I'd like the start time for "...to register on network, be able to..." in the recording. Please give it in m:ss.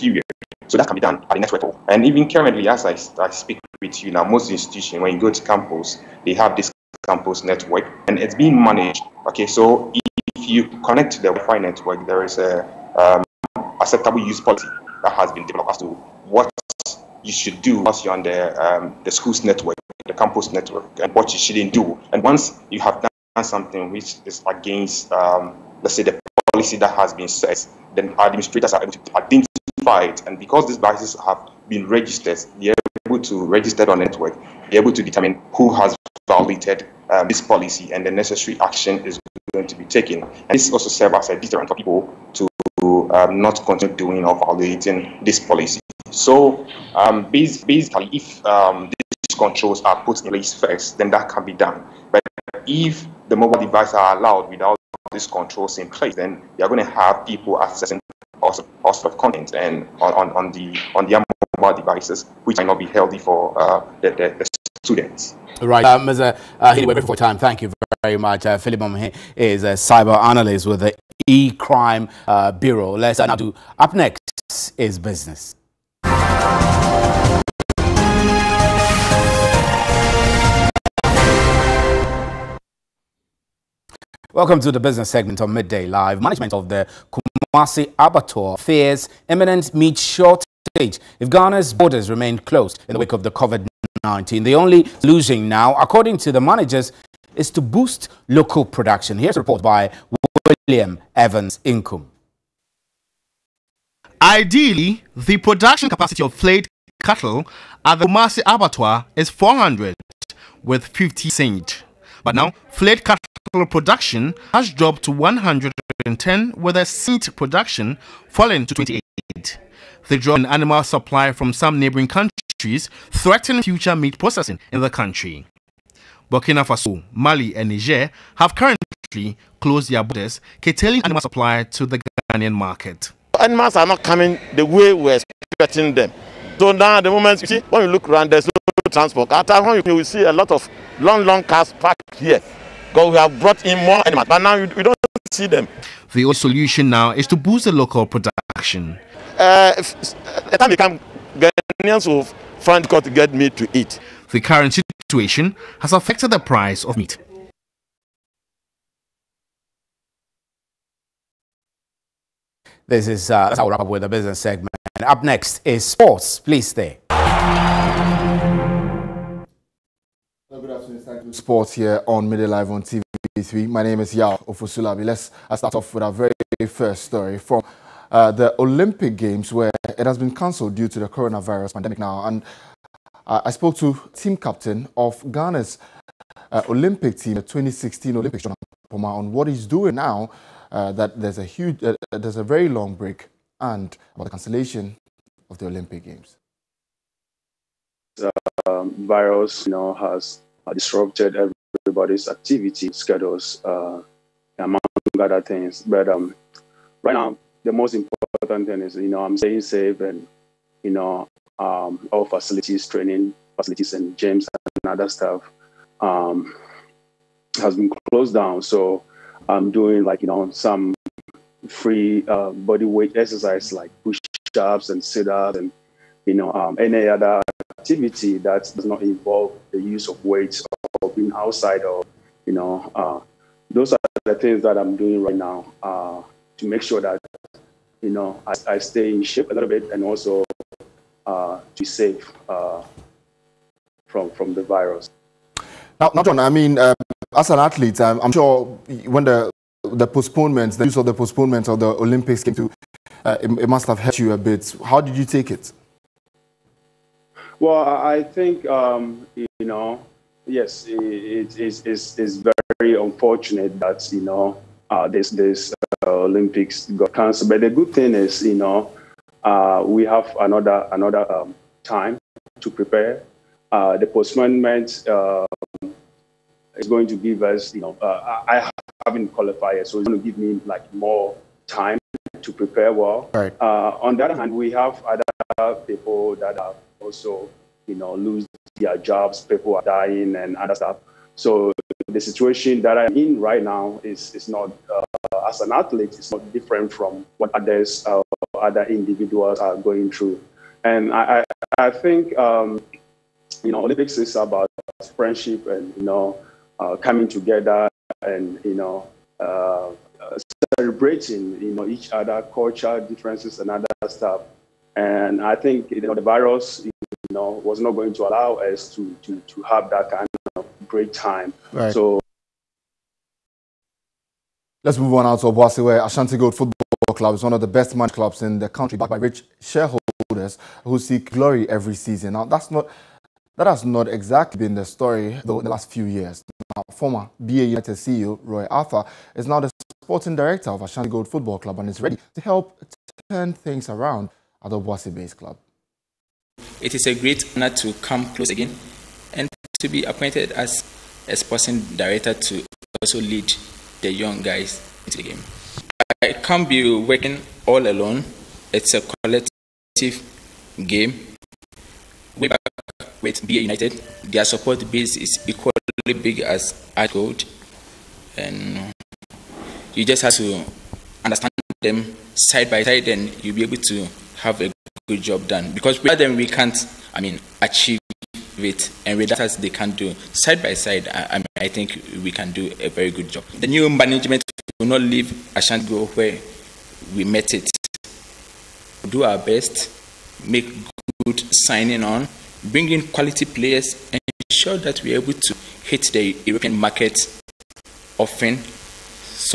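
0:33.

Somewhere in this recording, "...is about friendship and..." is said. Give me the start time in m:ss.
5:04.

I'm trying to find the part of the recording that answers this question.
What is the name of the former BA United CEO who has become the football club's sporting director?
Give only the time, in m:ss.
5:38.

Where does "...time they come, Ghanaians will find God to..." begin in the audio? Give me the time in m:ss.
2:30.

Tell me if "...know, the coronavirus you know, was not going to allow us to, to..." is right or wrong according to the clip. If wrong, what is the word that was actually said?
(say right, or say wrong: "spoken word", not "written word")
wrong: "virus", not "coronavirus".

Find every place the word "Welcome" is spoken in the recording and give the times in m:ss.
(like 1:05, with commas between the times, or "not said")
1:24.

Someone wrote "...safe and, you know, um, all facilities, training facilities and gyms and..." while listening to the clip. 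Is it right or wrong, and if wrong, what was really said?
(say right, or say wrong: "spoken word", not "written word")
right.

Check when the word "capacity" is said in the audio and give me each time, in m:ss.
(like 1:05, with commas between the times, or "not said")
1:45.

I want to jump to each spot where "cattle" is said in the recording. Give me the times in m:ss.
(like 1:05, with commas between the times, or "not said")
1:47, 1:53.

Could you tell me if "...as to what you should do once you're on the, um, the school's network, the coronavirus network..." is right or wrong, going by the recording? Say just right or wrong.
wrong.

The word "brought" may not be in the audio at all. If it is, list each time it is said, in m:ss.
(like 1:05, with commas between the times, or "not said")
2:23.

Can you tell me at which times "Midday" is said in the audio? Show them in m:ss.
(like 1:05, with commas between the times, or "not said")
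1:25, 2:52.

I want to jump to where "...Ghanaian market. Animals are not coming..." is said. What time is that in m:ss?
2:11.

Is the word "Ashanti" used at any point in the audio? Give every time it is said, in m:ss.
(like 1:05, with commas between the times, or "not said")
5:26, 5:40, 6:25.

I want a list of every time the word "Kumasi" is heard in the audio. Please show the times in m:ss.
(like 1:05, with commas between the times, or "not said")
1:27, 1:48.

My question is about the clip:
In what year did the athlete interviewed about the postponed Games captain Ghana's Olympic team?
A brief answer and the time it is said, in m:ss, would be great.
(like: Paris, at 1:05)
2016, at 3:07.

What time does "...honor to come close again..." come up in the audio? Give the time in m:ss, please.
5:47.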